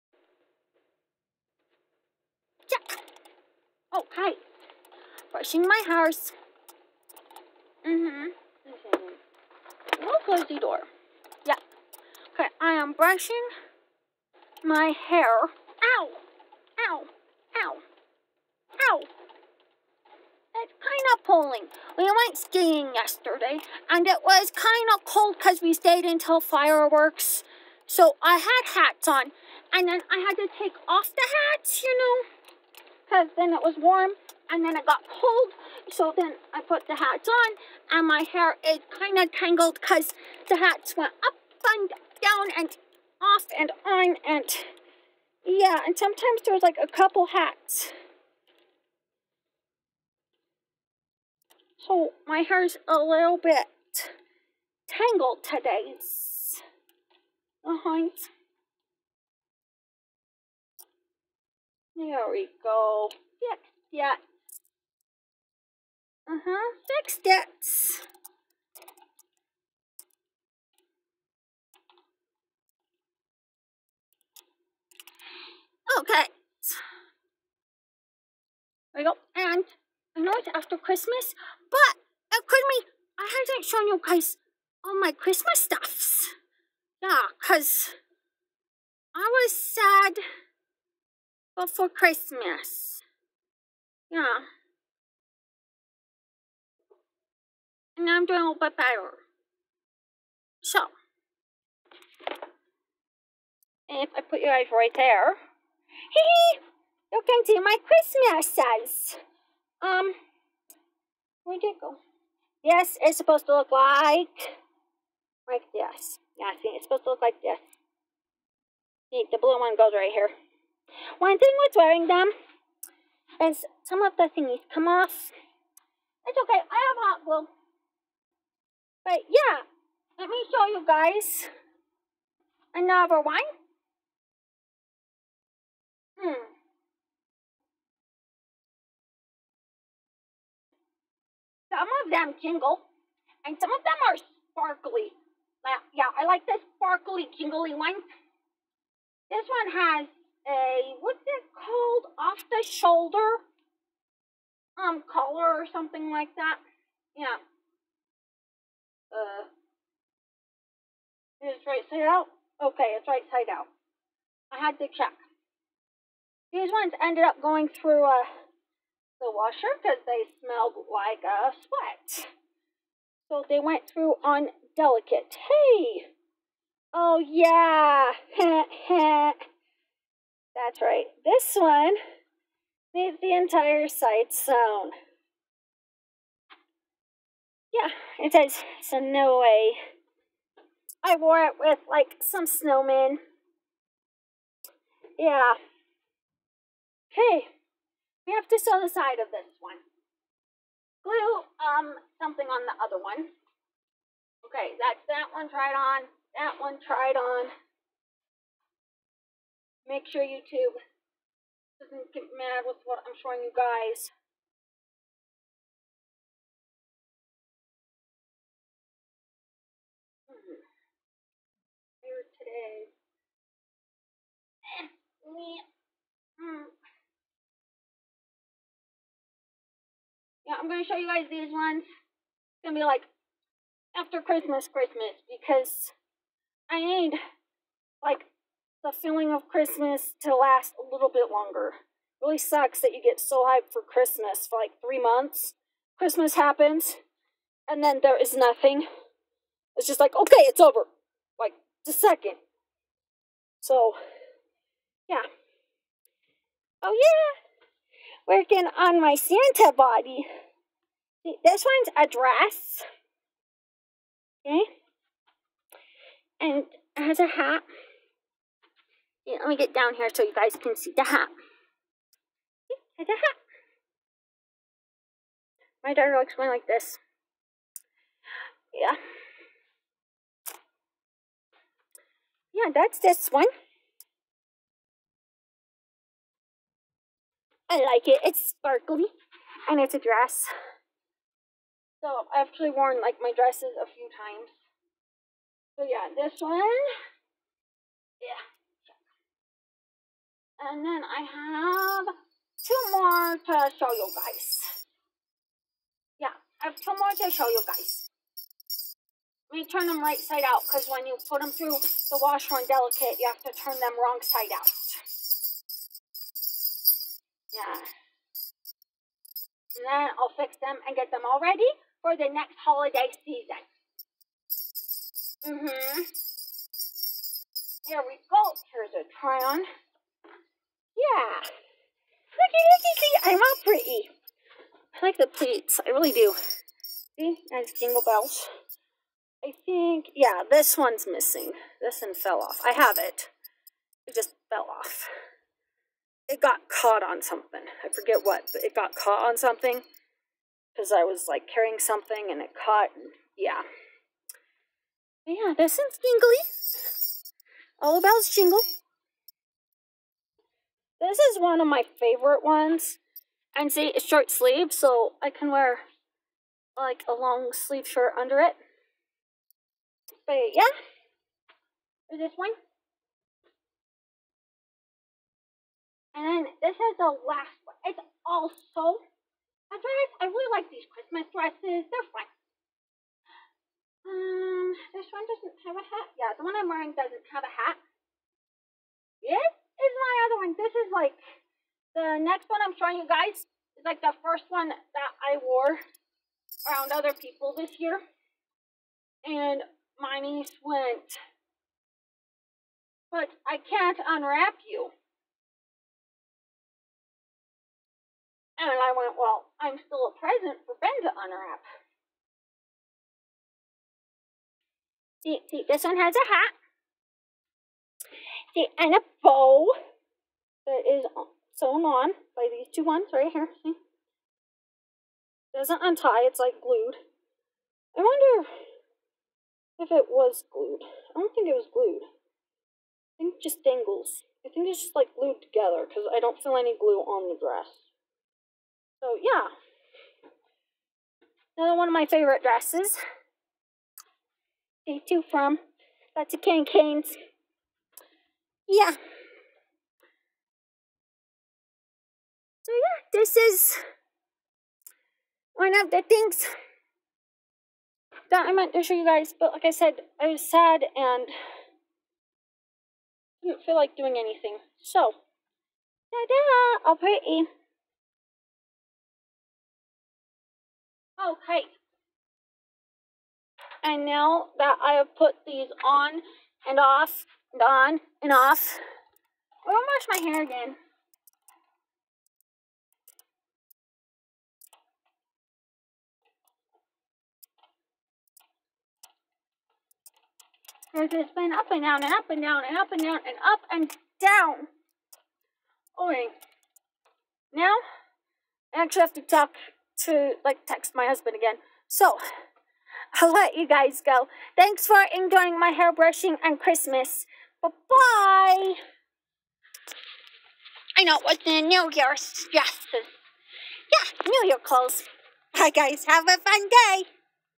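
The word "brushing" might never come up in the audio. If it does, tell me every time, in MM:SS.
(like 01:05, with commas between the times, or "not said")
00:05, 00:12, 08:25.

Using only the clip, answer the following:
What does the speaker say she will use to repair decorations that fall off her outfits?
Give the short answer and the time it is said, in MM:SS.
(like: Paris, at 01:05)
Hot glue, at 02:07.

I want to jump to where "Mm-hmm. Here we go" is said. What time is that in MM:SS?
05:25.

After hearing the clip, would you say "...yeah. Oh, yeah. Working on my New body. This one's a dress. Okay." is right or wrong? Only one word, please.
wrong.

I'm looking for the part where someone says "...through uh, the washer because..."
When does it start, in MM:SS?
02:47.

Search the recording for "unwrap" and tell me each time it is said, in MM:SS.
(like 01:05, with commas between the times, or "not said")
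06:44, 06:51.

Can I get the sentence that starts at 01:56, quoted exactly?
Yeah, see, it's supposed to look like this.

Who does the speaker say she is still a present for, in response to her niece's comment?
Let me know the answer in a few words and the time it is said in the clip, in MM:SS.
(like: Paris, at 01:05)
Ben, at 06:50.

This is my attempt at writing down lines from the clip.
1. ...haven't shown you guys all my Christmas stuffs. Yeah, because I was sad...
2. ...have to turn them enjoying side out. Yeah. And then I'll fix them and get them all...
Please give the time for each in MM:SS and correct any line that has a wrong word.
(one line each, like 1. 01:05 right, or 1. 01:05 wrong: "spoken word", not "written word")
1. 01:23 right
2. 05:13 wrong: "wrong", not "enjoying".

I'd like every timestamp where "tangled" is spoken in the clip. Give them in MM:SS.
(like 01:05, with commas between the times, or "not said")
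00:39, 00:54.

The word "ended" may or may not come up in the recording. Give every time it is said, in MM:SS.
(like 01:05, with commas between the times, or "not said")
02:47.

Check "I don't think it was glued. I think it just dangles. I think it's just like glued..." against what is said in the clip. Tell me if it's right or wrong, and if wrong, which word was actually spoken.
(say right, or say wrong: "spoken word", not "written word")
right.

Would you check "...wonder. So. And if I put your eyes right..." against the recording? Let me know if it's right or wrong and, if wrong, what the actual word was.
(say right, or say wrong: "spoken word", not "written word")
wrong: "better", not "wonder".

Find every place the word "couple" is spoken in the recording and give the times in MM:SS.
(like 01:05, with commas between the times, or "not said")
00:46.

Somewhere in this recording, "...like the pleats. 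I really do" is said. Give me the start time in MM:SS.
05:35.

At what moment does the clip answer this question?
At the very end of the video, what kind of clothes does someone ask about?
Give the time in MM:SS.
08:34.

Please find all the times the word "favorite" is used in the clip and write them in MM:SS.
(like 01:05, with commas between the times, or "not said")
06:01, 07:22.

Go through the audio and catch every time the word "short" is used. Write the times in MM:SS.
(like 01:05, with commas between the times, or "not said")
06:04.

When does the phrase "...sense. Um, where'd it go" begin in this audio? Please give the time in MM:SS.
01:48.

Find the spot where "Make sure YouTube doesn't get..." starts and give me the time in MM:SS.
03:29.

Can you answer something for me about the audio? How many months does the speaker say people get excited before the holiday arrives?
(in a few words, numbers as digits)
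3.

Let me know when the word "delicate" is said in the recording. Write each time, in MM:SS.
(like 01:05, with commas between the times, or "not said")
02:54, 05:12.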